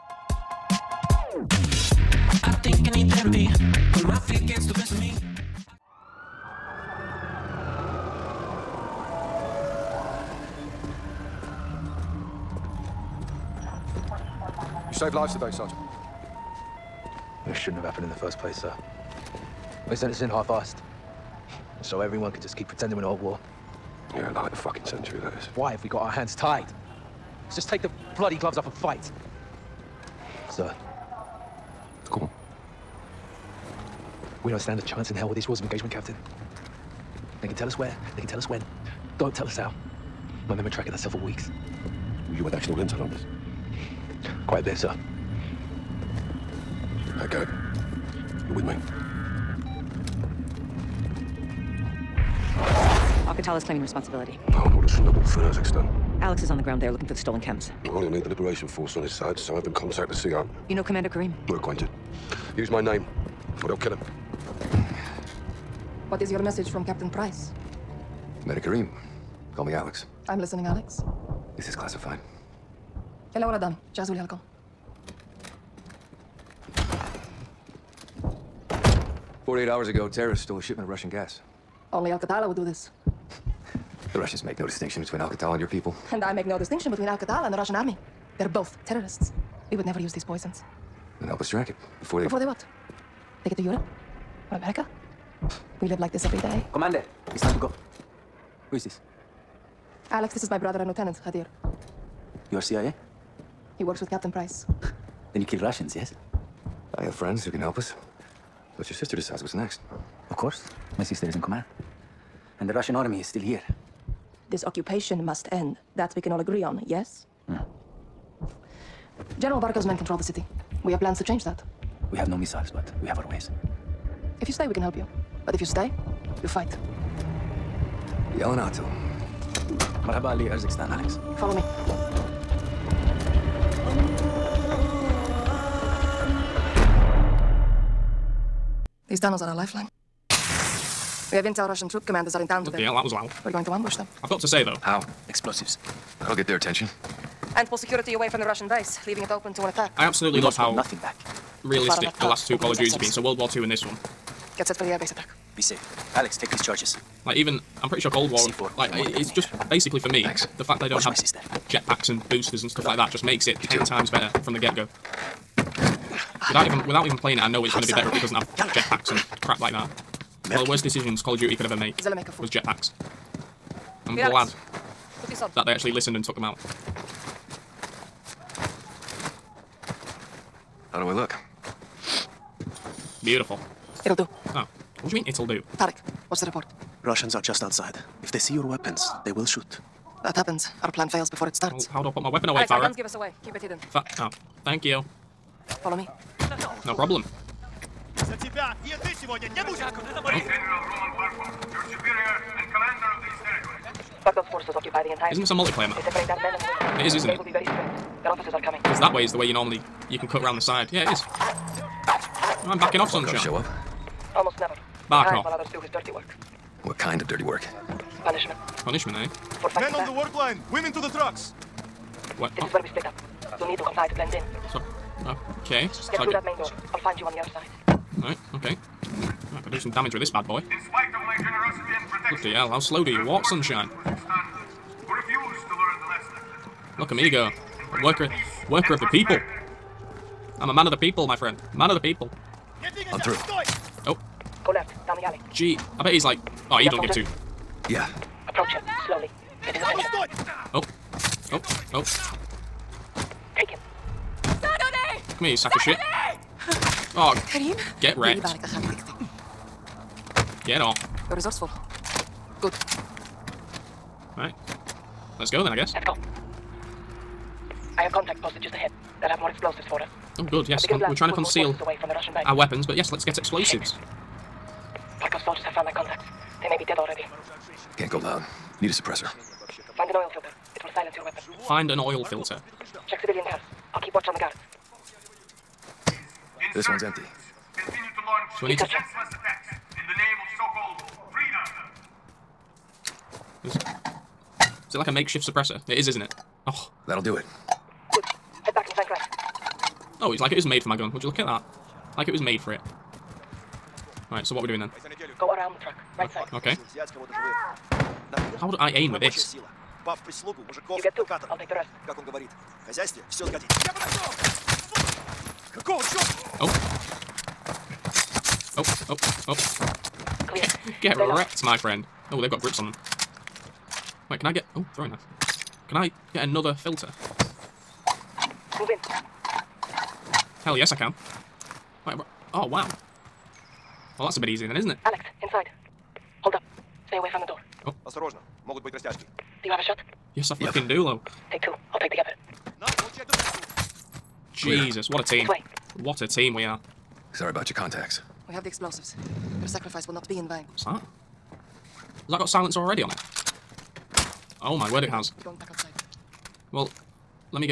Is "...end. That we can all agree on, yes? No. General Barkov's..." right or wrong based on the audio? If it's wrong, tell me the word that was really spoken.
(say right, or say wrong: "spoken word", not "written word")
right.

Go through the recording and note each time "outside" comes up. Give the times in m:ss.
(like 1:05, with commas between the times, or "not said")
3:07, 5:55.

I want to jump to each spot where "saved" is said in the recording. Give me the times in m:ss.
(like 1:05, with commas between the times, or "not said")
0:14.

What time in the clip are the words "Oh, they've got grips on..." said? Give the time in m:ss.
5:22.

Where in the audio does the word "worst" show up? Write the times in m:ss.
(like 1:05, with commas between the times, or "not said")
2:50.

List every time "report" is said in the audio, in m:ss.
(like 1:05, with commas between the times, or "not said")
3:06.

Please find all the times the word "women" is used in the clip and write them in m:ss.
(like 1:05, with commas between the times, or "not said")
3:26, 3:40.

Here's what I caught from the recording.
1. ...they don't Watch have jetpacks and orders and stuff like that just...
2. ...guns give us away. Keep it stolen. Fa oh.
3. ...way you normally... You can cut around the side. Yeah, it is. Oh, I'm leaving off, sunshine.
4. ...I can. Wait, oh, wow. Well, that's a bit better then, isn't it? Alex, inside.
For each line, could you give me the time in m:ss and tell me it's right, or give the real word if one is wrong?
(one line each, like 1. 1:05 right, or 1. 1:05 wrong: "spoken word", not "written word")
1. 2:40 wrong: "boosters", not "orders"
2. 3:12 wrong: "hidden", not "stolen"
3. 3:29 wrong: "backing", not "leaving"
4. 5:30 wrong: "easier", not "better".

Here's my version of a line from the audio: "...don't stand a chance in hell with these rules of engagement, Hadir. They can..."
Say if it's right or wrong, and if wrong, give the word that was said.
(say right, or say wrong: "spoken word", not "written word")
wrong: "Captain", not "Hadir".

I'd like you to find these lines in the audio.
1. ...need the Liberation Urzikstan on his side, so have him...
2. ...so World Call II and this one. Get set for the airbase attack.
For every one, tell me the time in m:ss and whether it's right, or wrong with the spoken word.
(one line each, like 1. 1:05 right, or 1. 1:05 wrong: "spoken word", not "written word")
1. 0:58 wrong: "Force", not "Urzikstan"
2. 2:33 wrong: "War", not "Call".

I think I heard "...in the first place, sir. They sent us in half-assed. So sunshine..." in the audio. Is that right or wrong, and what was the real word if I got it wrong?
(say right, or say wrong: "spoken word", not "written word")
wrong: "everyone", not "sunshine".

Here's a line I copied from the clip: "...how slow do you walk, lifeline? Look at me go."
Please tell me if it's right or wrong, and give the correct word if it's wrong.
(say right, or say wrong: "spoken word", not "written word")
wrong: "sunshine", not "lifeline".